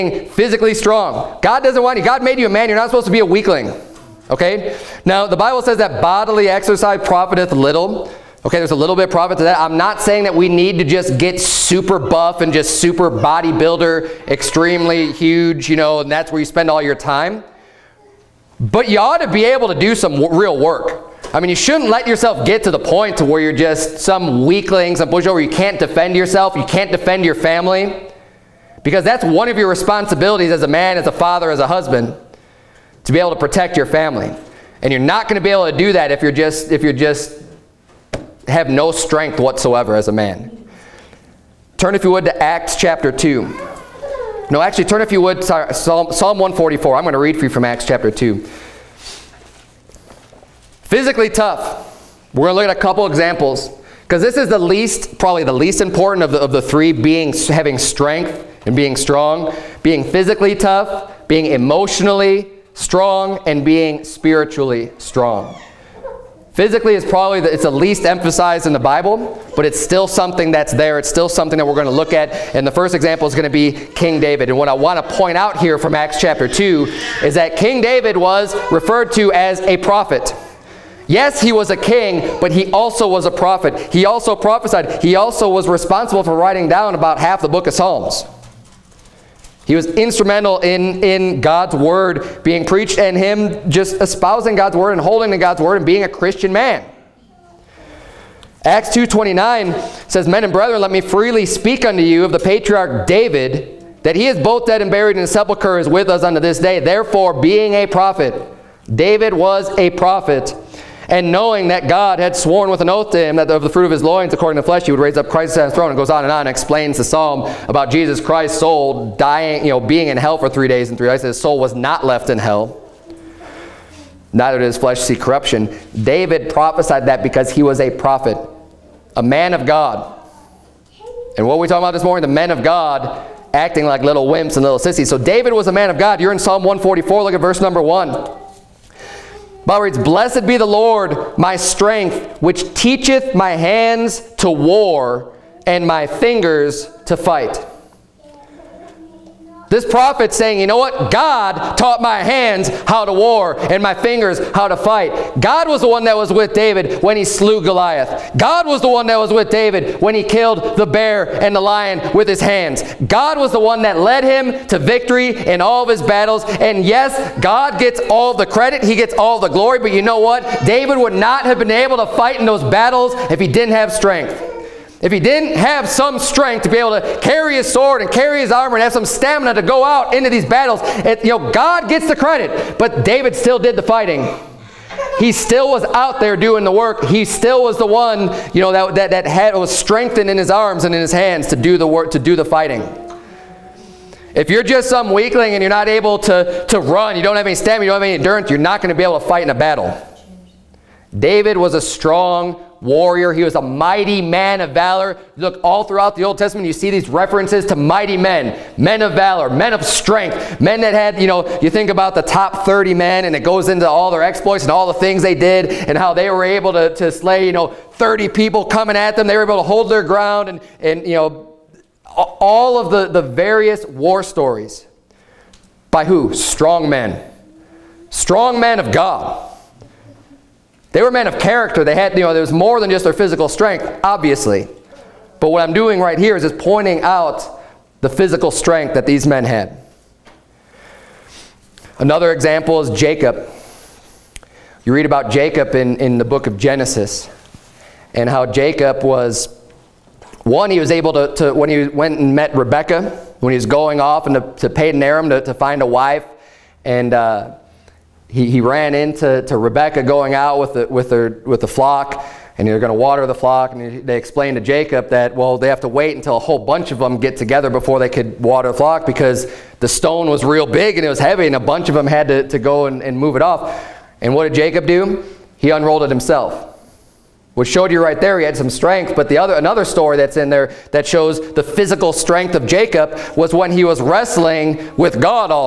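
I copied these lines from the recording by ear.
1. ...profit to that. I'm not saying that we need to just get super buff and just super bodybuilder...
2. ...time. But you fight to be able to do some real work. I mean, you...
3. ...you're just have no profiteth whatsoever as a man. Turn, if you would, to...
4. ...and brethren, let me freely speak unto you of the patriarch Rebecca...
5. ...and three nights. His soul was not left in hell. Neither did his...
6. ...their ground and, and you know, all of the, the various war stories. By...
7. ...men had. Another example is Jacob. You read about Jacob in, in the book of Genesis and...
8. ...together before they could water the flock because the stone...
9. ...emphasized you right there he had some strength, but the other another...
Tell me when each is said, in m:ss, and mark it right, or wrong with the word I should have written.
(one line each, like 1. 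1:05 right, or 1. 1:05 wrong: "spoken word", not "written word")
1. 0:09 right
2. 0:16 wrong: "ought", not "fight"
3. 0:36 wrong: "strength", not "profiteth"
4. 1:40 wrong: "David", not "Rebecca"
5. 2:00 right
6. 3:39 right
7. 3:59 right
8. 4:27 right
9. 4:37 wrong: "showed", not "emphasized".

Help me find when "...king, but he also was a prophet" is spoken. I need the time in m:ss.
1:21.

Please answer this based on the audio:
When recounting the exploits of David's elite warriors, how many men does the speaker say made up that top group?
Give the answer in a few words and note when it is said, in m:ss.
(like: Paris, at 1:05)
30, at 3:32.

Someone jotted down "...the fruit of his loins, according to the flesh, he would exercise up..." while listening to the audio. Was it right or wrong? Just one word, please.
wrong.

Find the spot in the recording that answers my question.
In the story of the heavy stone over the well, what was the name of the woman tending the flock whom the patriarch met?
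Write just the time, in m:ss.
4:12.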